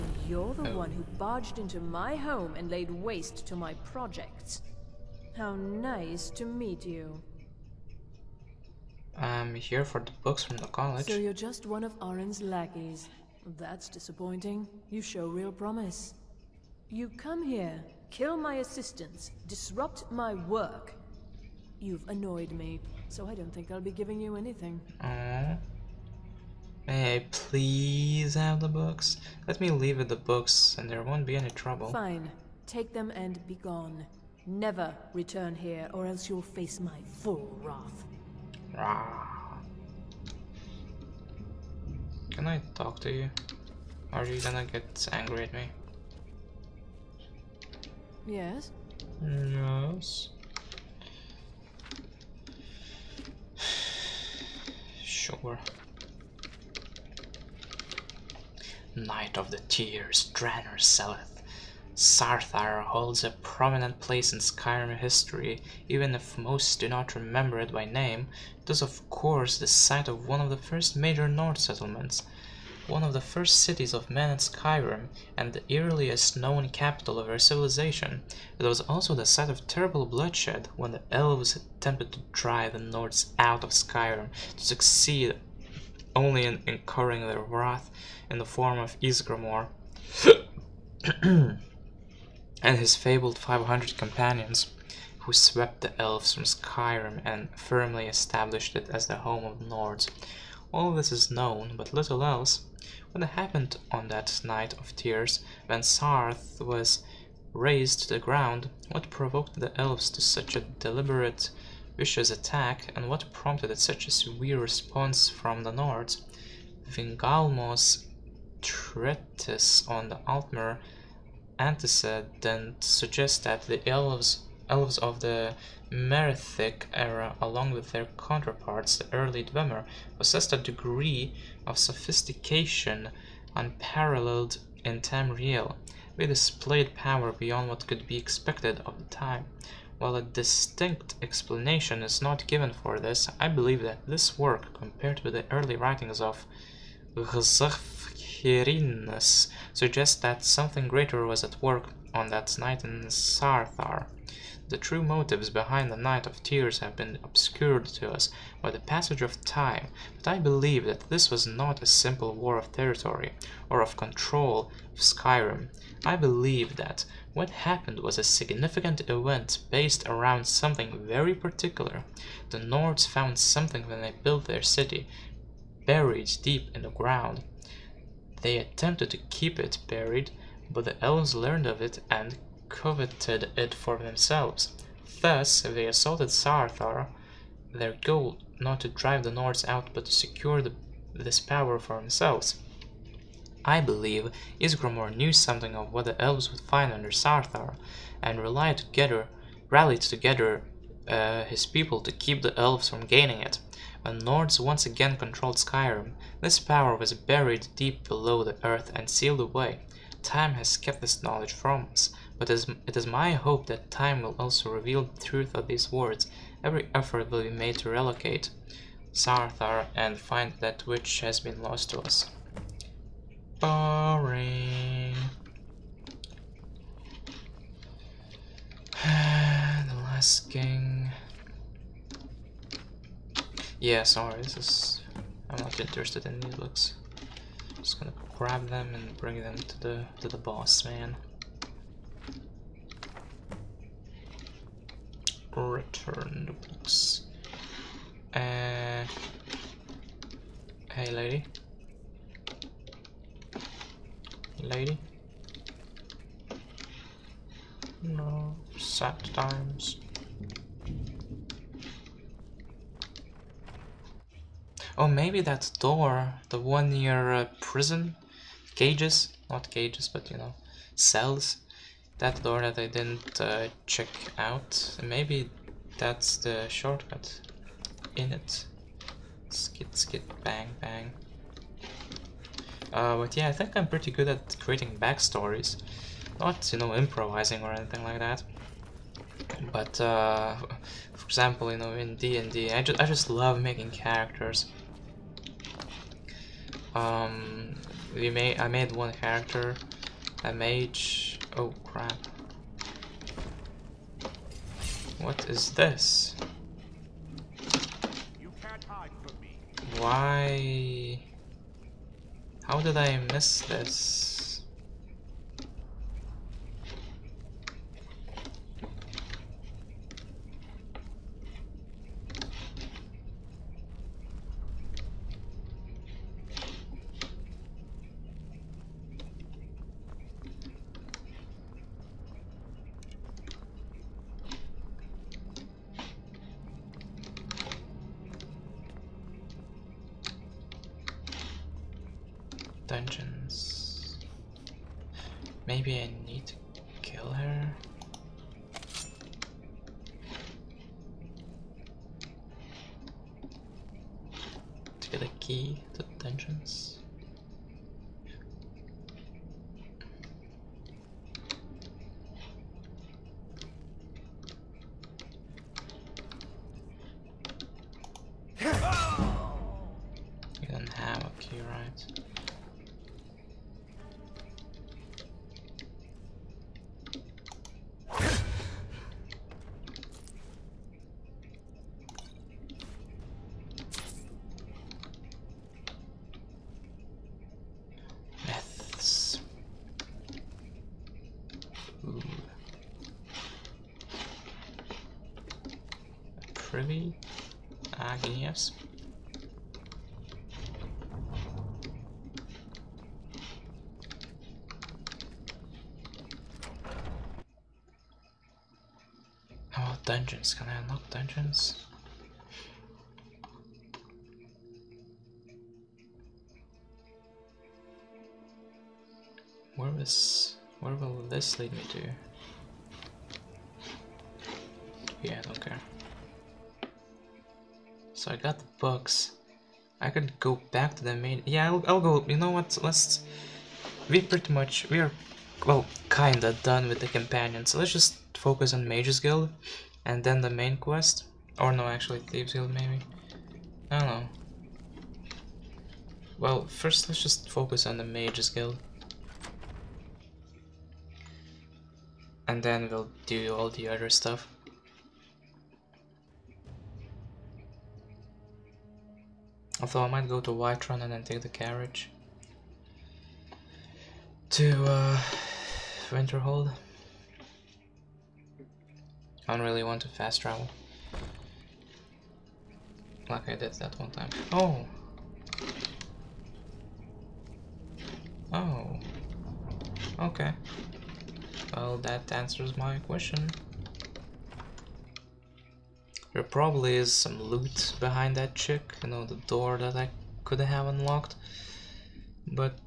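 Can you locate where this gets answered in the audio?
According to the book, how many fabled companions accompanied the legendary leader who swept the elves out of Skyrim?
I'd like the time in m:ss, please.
1:33.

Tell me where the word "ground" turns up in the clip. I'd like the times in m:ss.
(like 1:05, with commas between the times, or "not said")
1:48, 2:56.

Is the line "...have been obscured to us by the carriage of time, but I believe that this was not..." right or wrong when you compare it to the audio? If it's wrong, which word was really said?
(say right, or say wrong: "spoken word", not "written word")
wrong: "passage", not "carriage".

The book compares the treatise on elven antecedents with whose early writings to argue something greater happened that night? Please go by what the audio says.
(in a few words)
Gzafhirinnus.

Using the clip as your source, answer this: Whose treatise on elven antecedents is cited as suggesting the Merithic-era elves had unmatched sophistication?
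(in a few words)
Vingalmo.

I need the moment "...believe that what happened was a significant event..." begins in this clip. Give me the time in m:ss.
2:46.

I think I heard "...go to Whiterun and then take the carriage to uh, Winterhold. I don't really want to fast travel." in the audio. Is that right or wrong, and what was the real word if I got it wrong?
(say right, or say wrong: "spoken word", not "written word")
right.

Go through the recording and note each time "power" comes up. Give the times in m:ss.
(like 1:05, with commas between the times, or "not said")
2:16, 3:11, 3:26.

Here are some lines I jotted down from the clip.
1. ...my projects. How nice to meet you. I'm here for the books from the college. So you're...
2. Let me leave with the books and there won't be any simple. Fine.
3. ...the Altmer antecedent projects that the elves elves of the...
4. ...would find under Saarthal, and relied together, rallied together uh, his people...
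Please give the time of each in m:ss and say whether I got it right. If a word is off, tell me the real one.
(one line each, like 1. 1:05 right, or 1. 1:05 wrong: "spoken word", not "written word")
1. 0:03 right
2. 0:29 wrong: "trouble", not "simple"
3. 2:00 wrong: "suggests", not "projects"
4. 3:16 right.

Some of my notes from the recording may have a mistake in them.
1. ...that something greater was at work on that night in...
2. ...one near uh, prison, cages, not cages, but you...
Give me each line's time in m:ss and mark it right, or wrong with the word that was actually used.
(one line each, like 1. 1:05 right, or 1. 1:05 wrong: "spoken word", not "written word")
1. 2:30 right
2. 4:26 right.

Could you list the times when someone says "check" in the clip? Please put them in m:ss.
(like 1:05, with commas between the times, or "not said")
4:33.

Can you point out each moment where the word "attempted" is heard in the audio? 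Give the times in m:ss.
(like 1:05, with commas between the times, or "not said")
1:21, 2:58.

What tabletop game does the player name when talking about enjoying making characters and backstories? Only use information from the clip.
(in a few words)
D&D.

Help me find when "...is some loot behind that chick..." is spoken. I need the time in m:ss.
8:06.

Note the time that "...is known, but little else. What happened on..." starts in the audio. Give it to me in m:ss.
1:41.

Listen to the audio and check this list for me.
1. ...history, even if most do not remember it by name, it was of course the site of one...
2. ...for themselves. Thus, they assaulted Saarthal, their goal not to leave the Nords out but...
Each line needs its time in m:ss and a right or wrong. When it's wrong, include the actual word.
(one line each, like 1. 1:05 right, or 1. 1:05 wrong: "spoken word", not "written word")
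1. 1:04 right
2. 3:03 wrong: "drive", not "leave".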